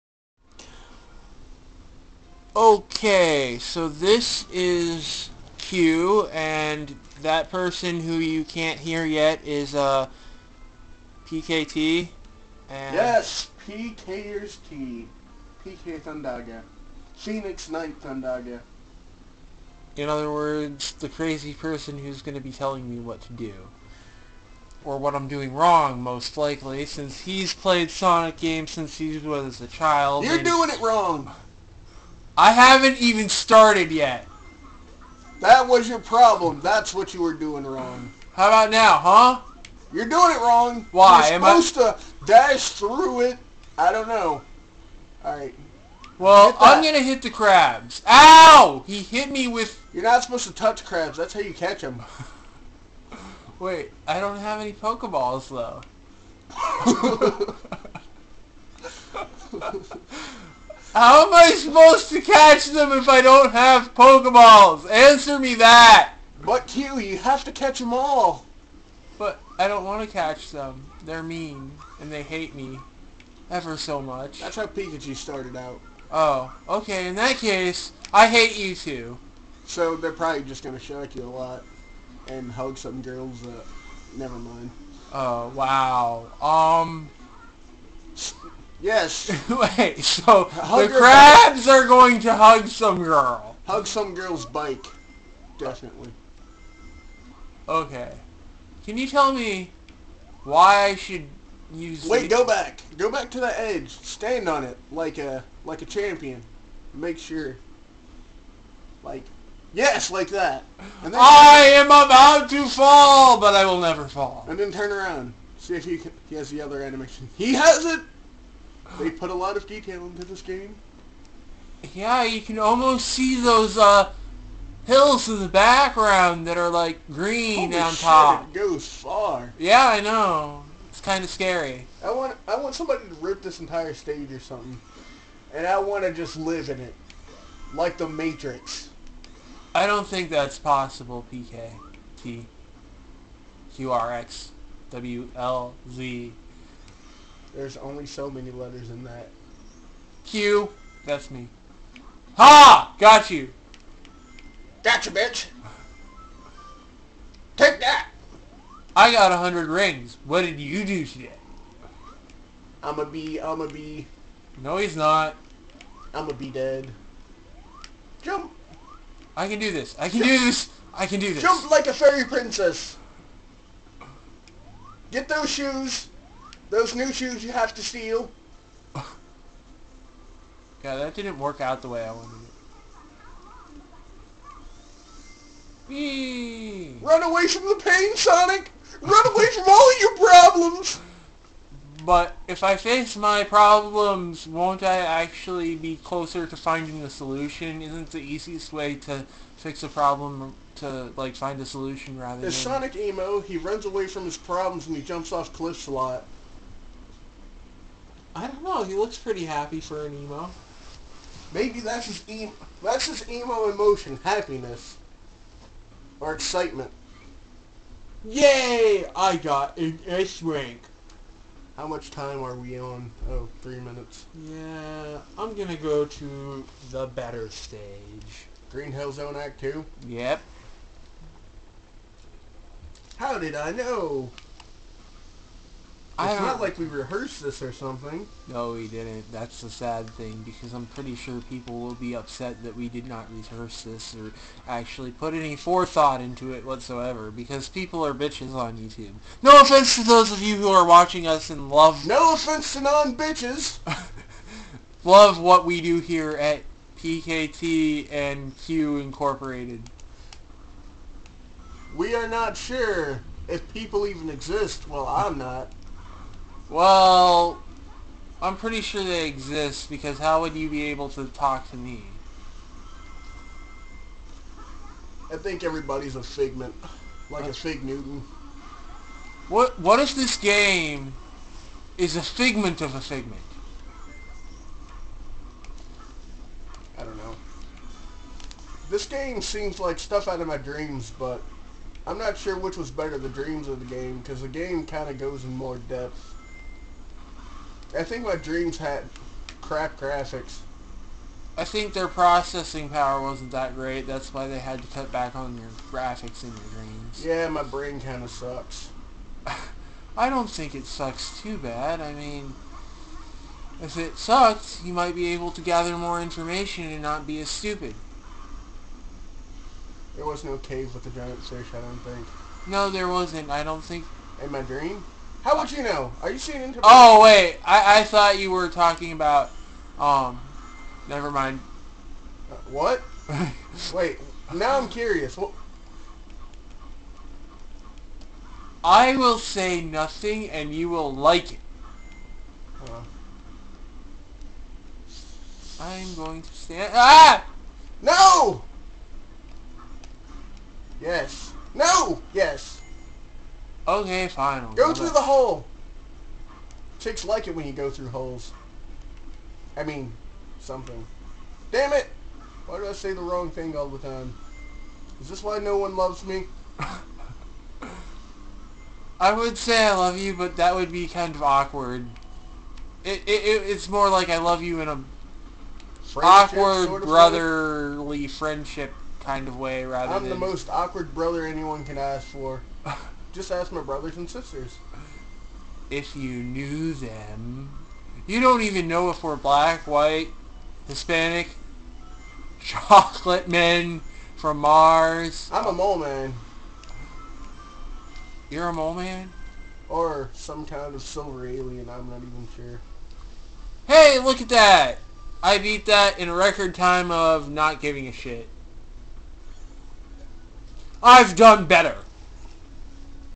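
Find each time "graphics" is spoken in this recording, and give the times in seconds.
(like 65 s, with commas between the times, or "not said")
299 s, 305 s.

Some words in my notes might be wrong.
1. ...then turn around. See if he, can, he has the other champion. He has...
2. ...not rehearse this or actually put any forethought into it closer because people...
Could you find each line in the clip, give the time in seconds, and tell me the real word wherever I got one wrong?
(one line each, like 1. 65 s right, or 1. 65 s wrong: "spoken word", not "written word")
1. 114 s wrong: "animation", not "champion"
2. 243 s wrong: "whatsoever", not "closer".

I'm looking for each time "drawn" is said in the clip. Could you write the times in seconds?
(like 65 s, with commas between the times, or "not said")
not said.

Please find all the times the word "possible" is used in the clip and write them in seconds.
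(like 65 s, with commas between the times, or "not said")
140 s.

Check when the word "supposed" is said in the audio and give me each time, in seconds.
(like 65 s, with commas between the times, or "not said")
41 s, 50 s, 61 s.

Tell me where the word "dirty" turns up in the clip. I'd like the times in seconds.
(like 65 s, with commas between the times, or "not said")
not said.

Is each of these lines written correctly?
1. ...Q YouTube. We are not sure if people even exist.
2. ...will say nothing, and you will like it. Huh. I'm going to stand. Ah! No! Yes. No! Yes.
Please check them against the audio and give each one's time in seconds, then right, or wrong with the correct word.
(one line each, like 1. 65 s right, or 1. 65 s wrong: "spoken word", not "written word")
1. 258 s wrong: "Incorporated", not "YouTube"
2. 339 s right.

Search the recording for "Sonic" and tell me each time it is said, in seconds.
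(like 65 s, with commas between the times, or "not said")
27 s, 188 s, 202 s.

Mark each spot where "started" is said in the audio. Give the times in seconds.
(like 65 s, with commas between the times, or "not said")
33 s, 75 s.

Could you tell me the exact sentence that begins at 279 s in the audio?
What What if this game is a figment of a figment?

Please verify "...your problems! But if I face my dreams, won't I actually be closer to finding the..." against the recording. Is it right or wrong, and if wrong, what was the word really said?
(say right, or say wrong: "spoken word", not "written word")
wrong: "problems", not "dreams".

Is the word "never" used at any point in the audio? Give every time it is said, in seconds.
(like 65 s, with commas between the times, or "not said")
84 s, 113 s, 331 s.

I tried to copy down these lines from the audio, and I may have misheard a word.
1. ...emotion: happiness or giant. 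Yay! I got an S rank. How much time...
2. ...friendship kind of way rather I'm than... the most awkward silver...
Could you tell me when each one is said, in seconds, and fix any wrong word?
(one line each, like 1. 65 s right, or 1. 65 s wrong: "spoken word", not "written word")
1. 213 s wrong: "excitement", not "giant"
2. 378 s wrong: "brother", not "silver".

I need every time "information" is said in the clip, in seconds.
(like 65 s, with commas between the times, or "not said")
316 s.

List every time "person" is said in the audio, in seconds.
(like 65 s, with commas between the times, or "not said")
7 s, 21 s.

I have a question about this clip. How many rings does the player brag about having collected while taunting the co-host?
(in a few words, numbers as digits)
100.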